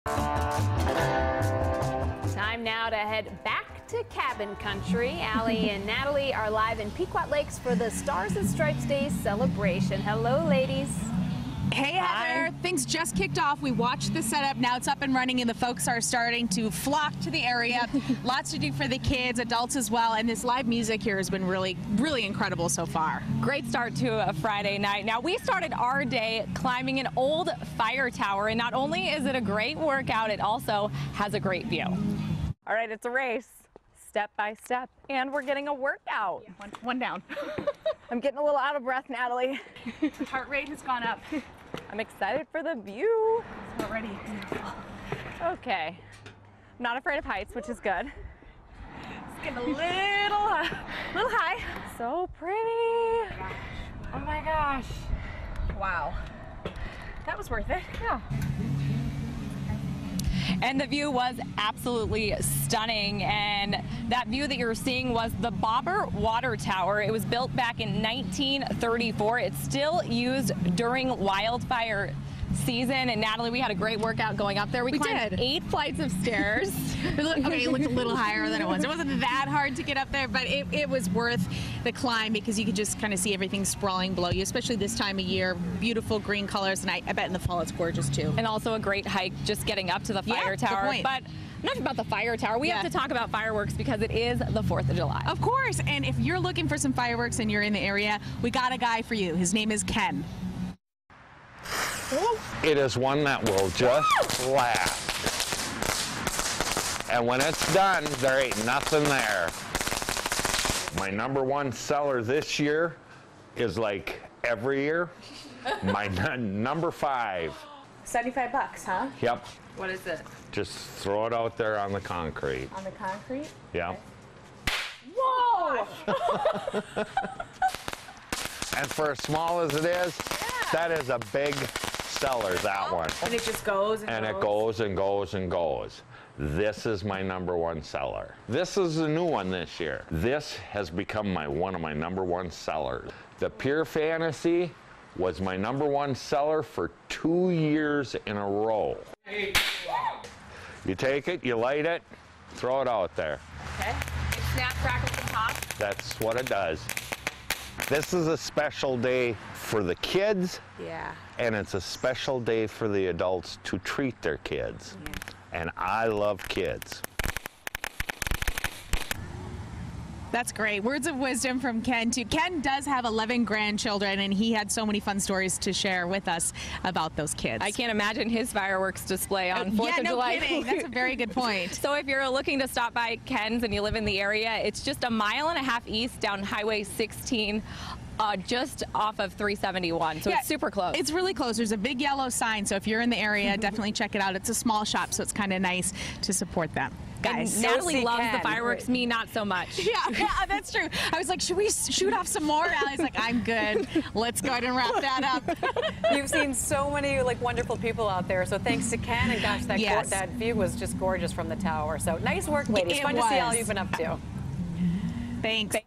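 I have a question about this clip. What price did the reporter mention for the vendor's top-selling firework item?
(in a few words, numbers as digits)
$75.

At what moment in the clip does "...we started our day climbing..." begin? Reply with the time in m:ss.
0:25.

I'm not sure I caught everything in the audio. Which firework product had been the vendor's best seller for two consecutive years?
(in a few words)
Pure Fantasy.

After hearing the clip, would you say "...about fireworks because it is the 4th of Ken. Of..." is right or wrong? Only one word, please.
wrong.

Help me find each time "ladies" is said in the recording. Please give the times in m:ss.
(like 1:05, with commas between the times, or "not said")
0:10, 3:32.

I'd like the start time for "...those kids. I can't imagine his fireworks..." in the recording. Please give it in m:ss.
2:57.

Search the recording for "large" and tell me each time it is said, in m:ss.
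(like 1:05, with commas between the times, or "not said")
not said.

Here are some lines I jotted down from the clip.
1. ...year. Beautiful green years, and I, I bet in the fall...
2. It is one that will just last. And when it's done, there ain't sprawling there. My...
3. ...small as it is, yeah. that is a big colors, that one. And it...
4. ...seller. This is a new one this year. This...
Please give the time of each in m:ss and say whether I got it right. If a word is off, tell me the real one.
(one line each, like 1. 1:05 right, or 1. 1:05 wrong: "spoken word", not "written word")
1. 1:25 wrong: "colors", not "years"
2. 1:42 wrong: "nothing", not "sprawling"
3. 2:09 wrong: "sellers", not "colors"
4. 2:17 right.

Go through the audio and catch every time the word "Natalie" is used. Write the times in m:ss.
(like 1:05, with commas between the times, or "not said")
0:05, 0:39, 1:13, 3:17.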